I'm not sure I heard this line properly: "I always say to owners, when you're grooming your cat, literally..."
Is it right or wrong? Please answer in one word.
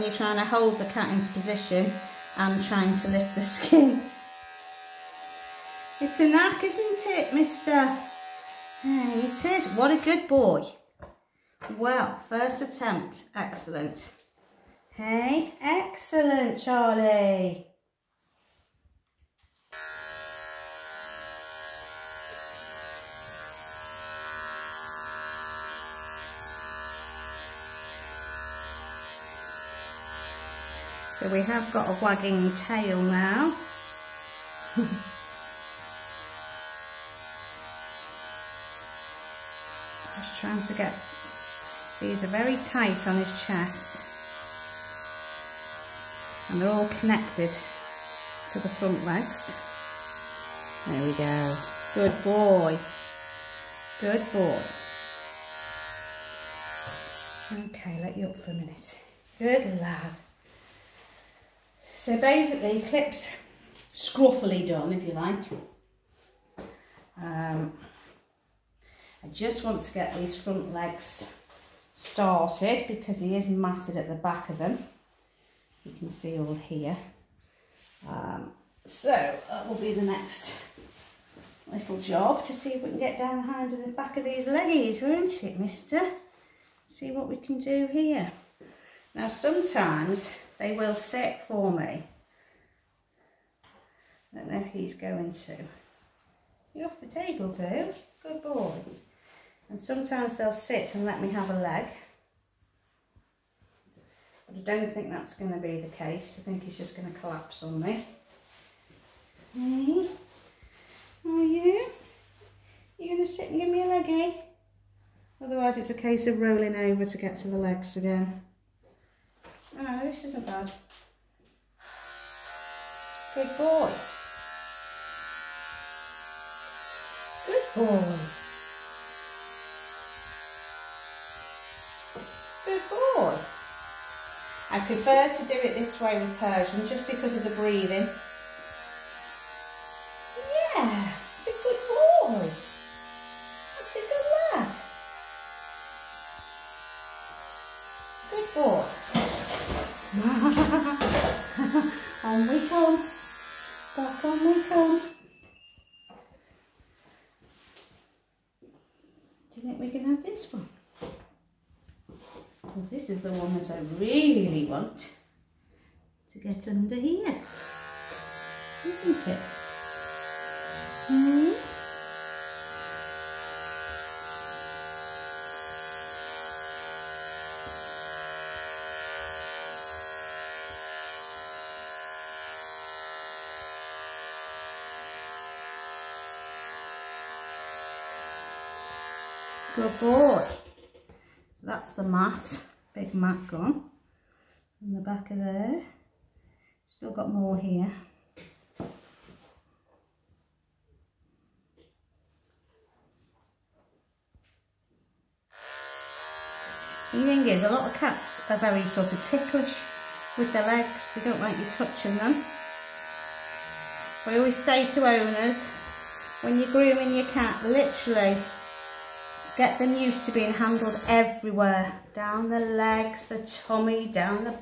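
right.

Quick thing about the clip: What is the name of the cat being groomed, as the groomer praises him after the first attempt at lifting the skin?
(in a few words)
Charlie.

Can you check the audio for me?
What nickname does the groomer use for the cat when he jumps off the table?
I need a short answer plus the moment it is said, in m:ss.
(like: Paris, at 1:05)
Boo, at 1:37.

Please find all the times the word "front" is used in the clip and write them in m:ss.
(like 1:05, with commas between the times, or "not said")
0:48, 1:10.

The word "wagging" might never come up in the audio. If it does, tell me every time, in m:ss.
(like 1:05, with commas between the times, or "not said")
0:32.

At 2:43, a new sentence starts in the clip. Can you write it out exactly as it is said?
this is the one that I really want to get under here, isn't it?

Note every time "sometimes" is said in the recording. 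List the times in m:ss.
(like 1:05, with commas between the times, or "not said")
1:29, 1:39.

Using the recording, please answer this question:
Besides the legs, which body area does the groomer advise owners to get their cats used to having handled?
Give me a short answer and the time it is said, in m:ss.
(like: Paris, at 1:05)
The tummy, at 3:43.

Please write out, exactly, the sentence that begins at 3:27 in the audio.
The thing is, a lot of cats are very sort of ticklish with their legs.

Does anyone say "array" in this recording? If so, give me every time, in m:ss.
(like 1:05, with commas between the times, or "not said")
not said.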